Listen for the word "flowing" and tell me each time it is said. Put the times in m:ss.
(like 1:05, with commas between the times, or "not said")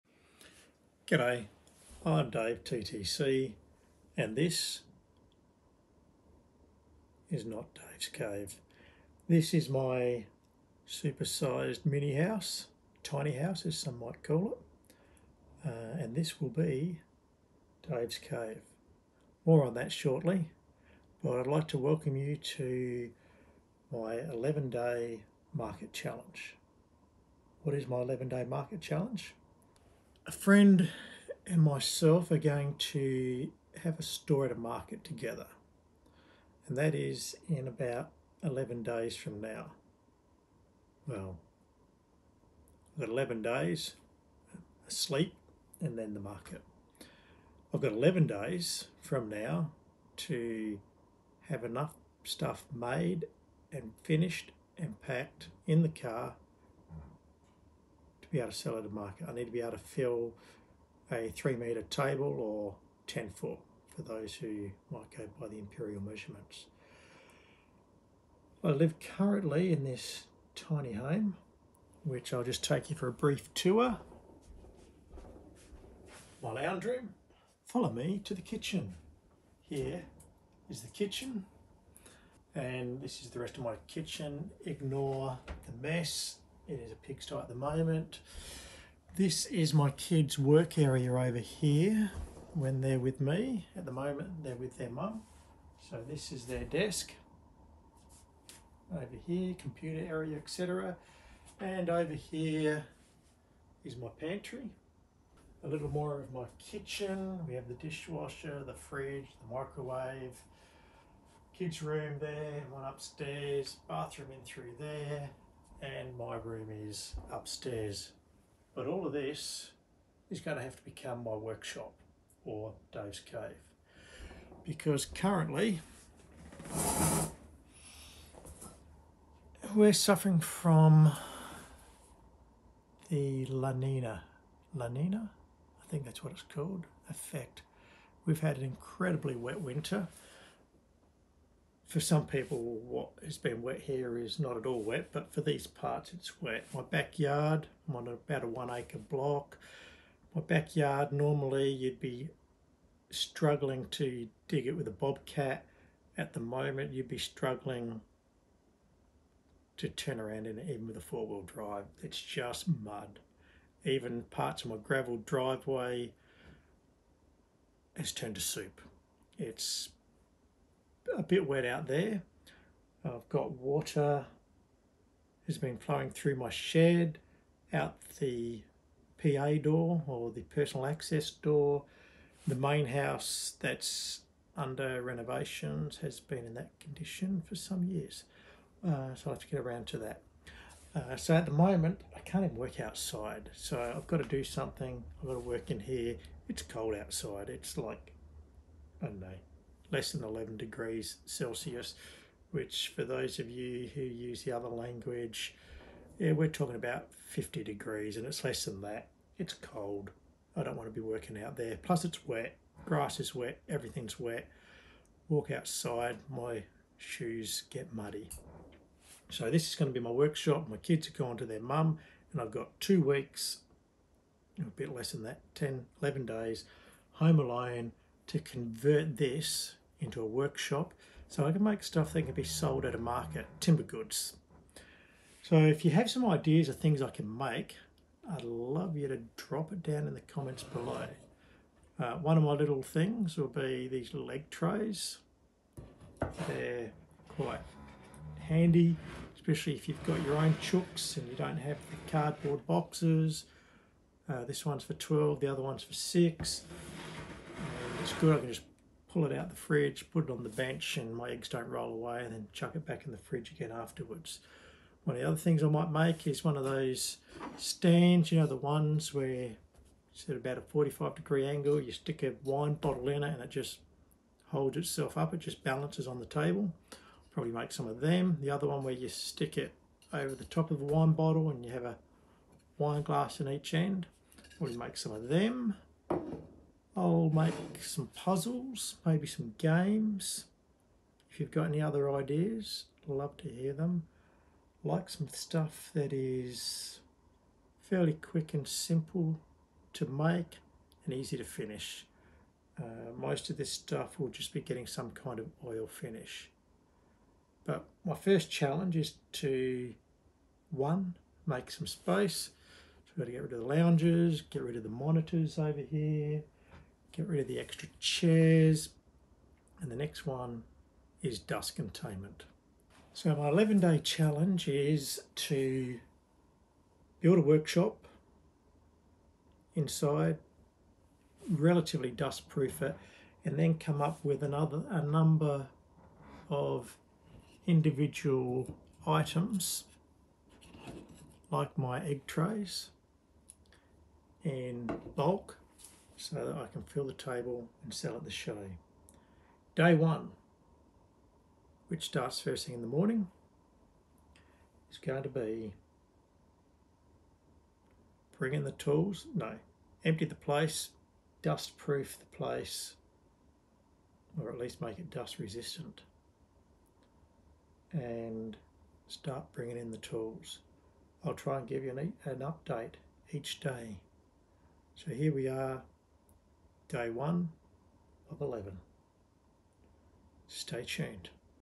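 2:55.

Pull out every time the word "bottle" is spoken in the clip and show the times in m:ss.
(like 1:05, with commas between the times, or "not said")
4:32, 4:41.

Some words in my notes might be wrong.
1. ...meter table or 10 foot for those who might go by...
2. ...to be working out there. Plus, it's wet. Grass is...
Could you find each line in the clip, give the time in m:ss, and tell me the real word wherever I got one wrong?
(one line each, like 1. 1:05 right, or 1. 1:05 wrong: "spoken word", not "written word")
1. 1:01 right
2. 3:30 right.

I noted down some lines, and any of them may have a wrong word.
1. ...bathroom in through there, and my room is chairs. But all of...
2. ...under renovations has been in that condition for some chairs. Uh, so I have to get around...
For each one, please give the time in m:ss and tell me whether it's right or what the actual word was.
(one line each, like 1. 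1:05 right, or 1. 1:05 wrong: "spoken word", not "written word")
1. 1:53 wrong: "upstairs", not "chairs"
2. 3:04 wrong: "years", not "chairs".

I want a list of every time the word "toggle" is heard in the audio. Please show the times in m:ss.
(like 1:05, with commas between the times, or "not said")
not said.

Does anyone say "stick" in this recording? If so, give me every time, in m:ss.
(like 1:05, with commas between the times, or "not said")
4:31, 4:39.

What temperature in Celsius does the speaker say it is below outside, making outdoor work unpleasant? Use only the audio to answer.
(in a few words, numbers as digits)
11 degrees Celsius.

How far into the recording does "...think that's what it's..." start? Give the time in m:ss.
2:15.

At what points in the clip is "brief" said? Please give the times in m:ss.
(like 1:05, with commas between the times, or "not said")
1:13.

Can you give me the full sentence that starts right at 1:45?
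A little more of my kitchen.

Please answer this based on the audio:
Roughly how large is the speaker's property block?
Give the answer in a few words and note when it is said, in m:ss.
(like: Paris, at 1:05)
1 acre, at 2:28.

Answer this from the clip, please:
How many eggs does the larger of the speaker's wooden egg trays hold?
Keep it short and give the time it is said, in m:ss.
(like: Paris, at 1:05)
12, at 4:14.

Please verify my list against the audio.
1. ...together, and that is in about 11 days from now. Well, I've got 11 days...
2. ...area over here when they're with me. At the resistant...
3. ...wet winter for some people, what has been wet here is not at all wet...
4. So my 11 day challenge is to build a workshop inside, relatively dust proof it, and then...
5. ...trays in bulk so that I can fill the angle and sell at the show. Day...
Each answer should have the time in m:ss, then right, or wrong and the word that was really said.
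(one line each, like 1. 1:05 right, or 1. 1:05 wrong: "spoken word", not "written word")
1. 0:35 right
2. 1:30 wrong: "moment", not "resistant"
3. 2:19 right
4. 5:23 right
5. 5:42 wrong: "table", not "angle".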